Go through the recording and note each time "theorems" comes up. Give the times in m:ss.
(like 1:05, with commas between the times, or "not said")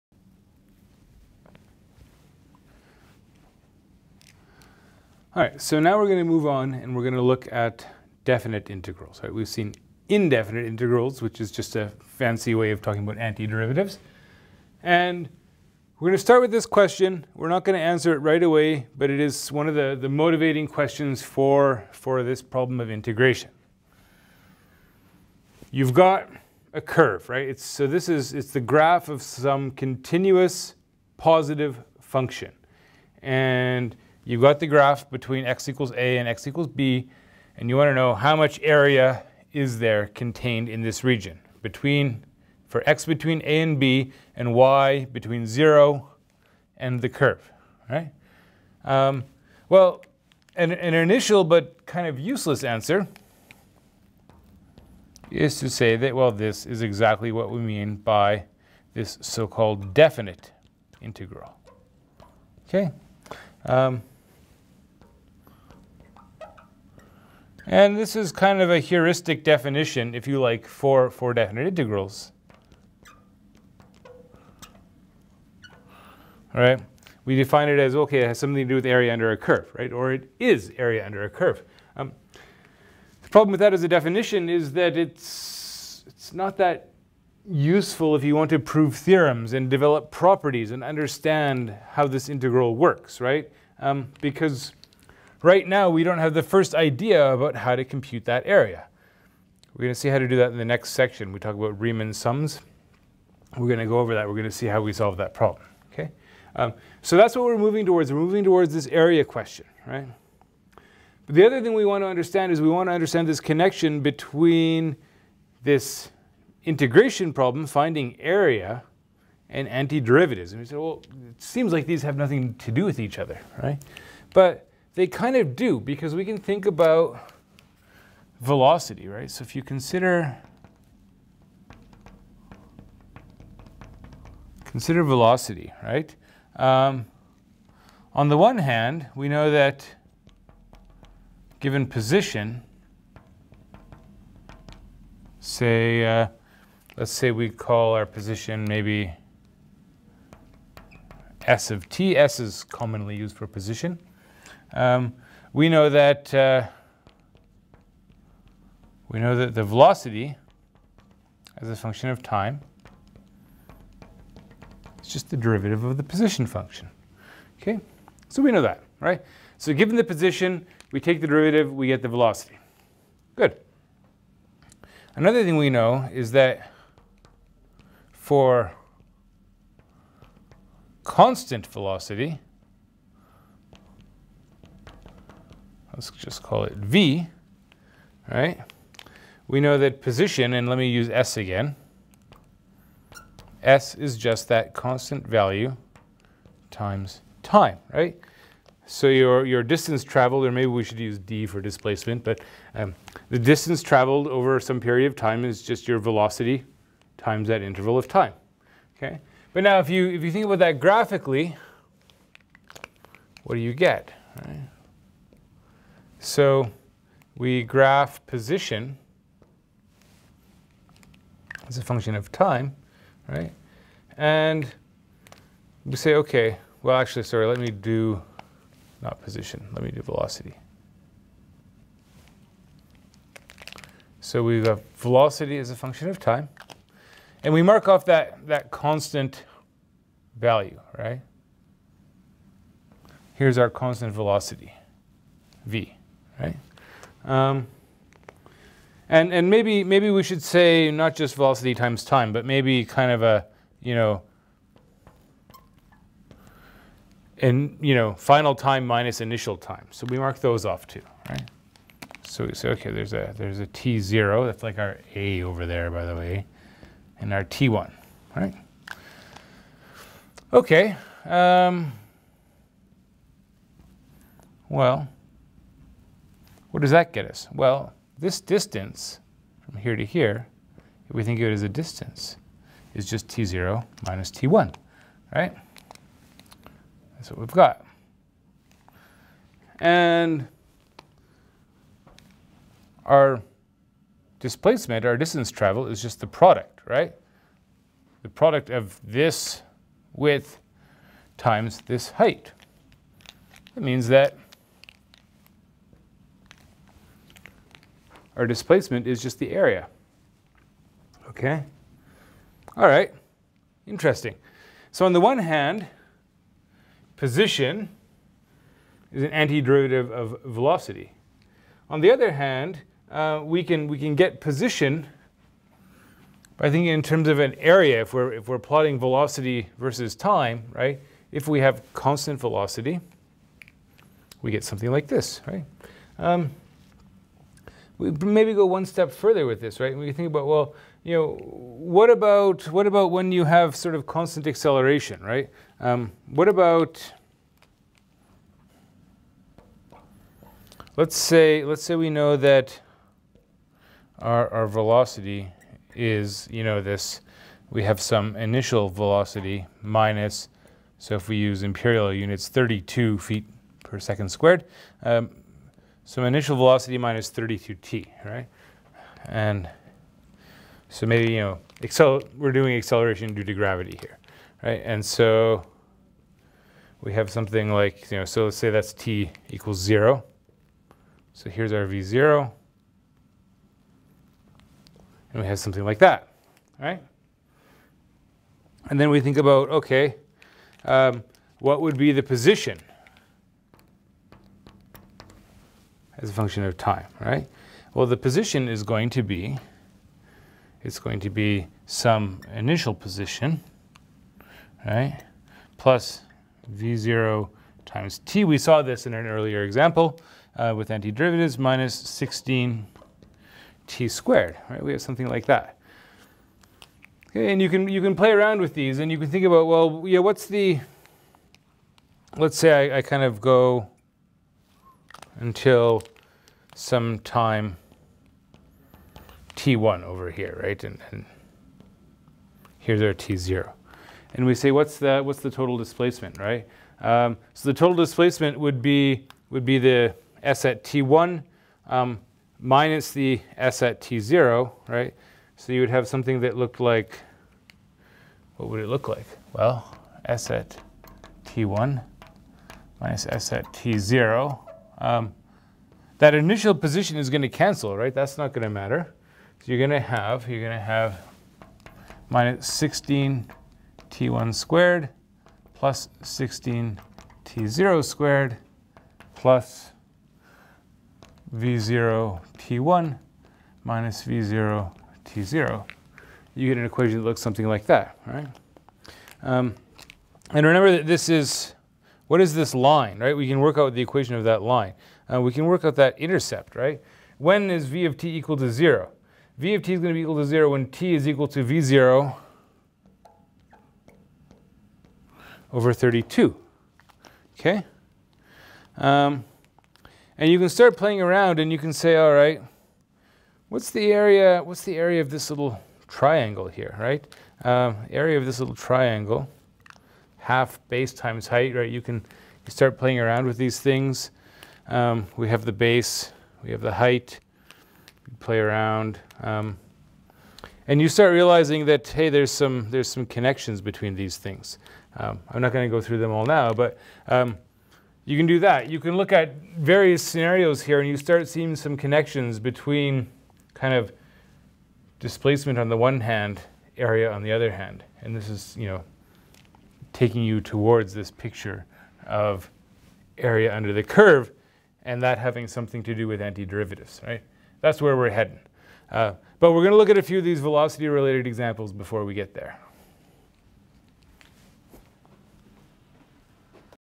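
1:28.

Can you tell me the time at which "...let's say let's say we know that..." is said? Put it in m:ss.
5:50.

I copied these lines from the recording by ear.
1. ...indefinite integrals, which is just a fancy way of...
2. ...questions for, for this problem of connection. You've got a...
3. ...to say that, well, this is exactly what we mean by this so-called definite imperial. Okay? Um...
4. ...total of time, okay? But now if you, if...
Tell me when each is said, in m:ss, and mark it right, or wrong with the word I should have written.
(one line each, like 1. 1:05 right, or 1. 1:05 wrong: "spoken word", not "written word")
1. 0:10 right
2. 0:20 wrong: "integration", not "connection"
3. 0:55 wrong: "integral", not "imperial"
4. 3:27 wrong: "interval", not "total".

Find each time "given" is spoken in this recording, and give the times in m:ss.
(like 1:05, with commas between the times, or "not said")
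2:21, 2:49.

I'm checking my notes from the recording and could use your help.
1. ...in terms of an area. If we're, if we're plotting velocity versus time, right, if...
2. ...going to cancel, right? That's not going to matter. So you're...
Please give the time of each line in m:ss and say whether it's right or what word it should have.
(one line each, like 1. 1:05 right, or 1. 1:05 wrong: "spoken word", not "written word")
1. 5:26 right
2. 7:37 right.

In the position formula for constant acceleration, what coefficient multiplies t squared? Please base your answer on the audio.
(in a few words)
16.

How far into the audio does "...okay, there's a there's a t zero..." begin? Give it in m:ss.
4:22.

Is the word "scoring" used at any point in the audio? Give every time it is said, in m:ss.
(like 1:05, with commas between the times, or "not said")
not said.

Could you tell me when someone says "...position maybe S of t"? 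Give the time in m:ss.
2:28.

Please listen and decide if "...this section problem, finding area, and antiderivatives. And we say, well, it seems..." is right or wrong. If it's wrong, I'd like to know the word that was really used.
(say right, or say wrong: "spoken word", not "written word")
wrong: "integration", not "section".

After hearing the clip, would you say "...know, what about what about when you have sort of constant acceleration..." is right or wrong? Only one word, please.
right.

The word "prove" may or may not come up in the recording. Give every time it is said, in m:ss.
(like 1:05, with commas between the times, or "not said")
1:28.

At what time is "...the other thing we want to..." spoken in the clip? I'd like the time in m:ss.
1:51.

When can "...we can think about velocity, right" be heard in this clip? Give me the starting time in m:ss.
2:06.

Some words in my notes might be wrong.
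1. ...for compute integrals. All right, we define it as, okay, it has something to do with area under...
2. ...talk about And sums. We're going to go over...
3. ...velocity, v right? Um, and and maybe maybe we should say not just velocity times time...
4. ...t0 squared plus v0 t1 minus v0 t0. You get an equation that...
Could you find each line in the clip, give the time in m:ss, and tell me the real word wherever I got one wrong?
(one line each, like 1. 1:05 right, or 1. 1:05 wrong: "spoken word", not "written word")
1. 1:11 wrong: "definite", not "compute"
2. 1:41 wrong: "Riemann", not "And"
3. 4:04 right
4. 7:47 right.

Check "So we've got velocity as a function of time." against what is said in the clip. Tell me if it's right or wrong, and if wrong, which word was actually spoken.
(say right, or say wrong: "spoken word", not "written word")
right.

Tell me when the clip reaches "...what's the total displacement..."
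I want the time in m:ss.
7:15.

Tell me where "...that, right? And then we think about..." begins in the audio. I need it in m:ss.
6:25.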